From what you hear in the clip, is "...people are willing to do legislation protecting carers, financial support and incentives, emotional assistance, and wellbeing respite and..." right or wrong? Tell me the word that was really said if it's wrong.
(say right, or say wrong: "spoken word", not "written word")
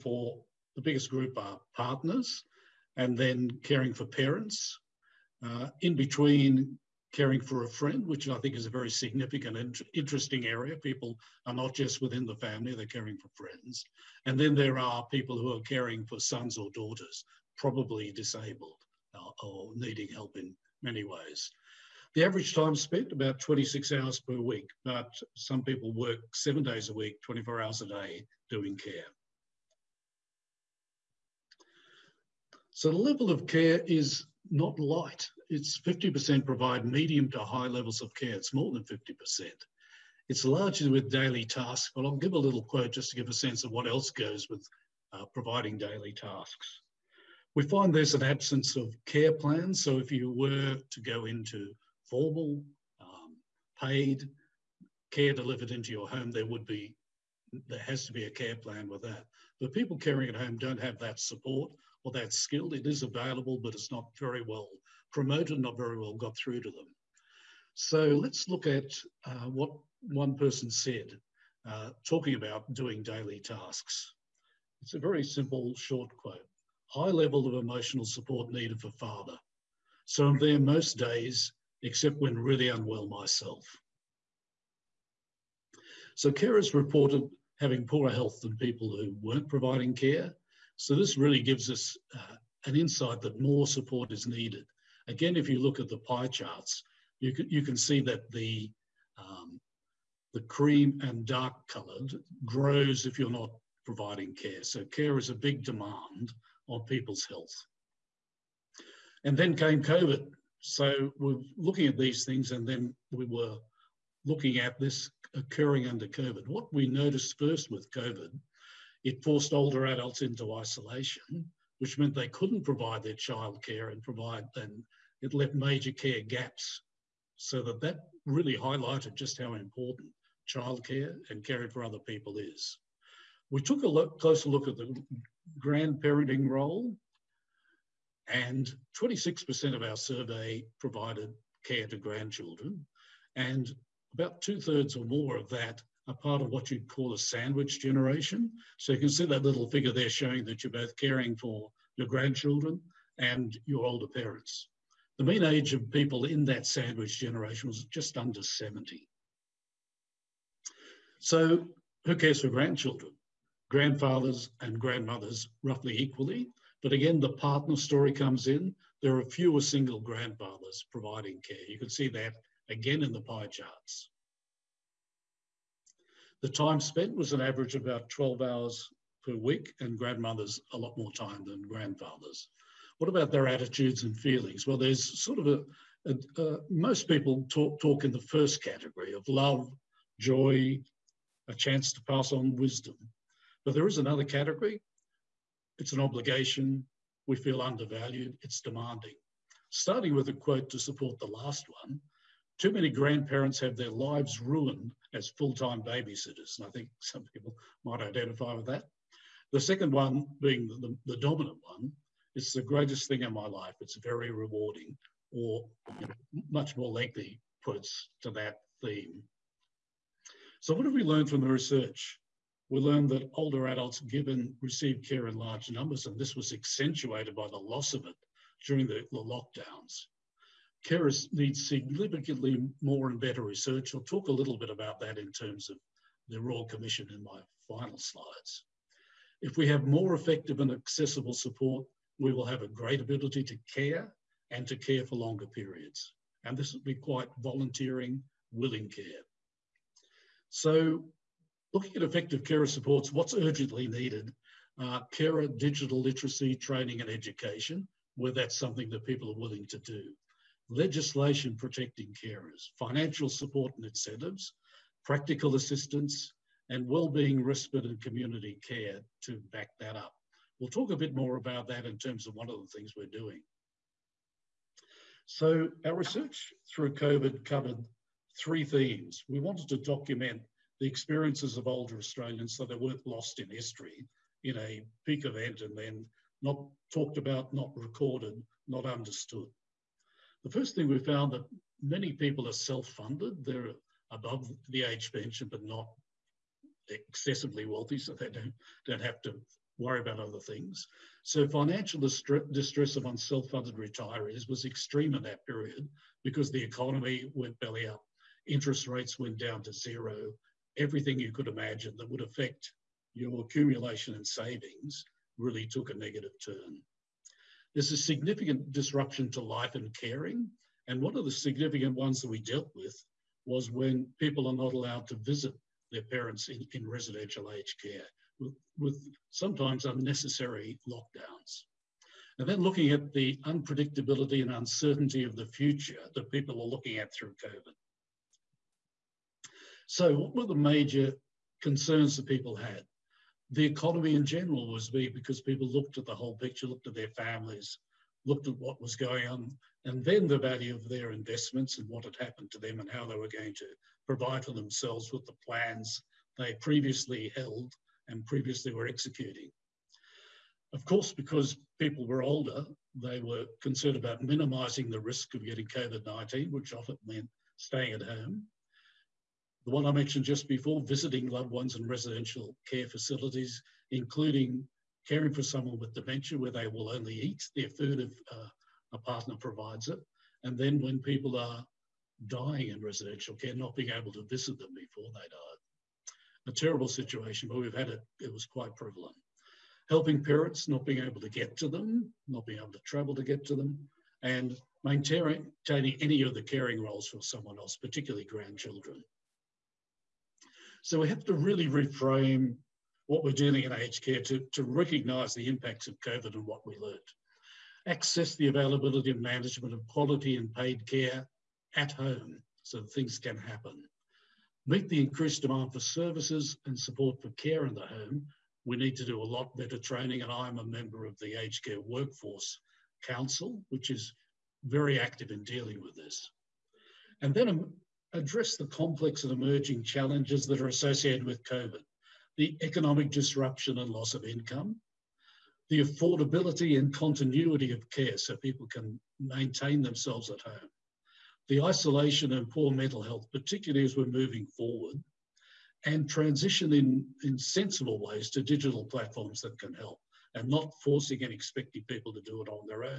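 wrong: "practical", not "emotional".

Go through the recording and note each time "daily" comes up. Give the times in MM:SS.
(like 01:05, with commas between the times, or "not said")
00:41, 00:45, 01:13.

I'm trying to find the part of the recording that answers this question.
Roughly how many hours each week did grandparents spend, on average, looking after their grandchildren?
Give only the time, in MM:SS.
02:58.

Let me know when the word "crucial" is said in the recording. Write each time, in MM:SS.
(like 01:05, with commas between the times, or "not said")
not said.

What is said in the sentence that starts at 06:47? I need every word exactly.
Access the availability and management of quality and paid care at home so things can happen.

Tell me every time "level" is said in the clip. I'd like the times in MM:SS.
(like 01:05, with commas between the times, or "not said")
00:32, 00:37, 01:17.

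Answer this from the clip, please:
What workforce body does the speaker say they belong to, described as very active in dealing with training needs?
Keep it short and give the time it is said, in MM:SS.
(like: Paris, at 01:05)
Aged Care Workforce Council, at 07:01.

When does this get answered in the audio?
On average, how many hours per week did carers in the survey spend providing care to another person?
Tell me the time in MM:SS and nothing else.
00:23.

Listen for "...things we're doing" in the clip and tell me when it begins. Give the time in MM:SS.
04:32.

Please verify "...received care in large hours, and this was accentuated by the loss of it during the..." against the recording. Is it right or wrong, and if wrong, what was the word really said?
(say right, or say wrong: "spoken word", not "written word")
wrong: "numbers", not "hours".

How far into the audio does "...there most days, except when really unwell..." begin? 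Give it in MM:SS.
01:20.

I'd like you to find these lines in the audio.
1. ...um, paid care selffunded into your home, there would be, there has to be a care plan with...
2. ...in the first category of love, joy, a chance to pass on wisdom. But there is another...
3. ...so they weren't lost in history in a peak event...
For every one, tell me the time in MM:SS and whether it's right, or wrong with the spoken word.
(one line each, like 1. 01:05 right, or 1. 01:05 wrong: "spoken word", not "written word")
1. 00:53 wrong: "delivered", not "selffunded"
2. 03:08 right
3. 04:42 right.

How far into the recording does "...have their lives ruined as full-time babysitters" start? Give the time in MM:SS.
03:23.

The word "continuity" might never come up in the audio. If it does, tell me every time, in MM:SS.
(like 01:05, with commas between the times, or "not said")
07:16.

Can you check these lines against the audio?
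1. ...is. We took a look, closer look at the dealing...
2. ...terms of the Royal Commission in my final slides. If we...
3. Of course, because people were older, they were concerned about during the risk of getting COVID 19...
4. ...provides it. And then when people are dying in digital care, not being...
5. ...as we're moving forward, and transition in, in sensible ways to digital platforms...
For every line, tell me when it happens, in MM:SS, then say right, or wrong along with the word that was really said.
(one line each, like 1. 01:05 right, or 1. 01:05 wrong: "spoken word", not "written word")
1. 02:12 wrong: "grandparenting", not "dealing"
2. 03:55 right
3. 06:00 wrong: "minimizing", not "during"
4. 06:19 wrong: "residential", not "digital"
5. 07:23 right.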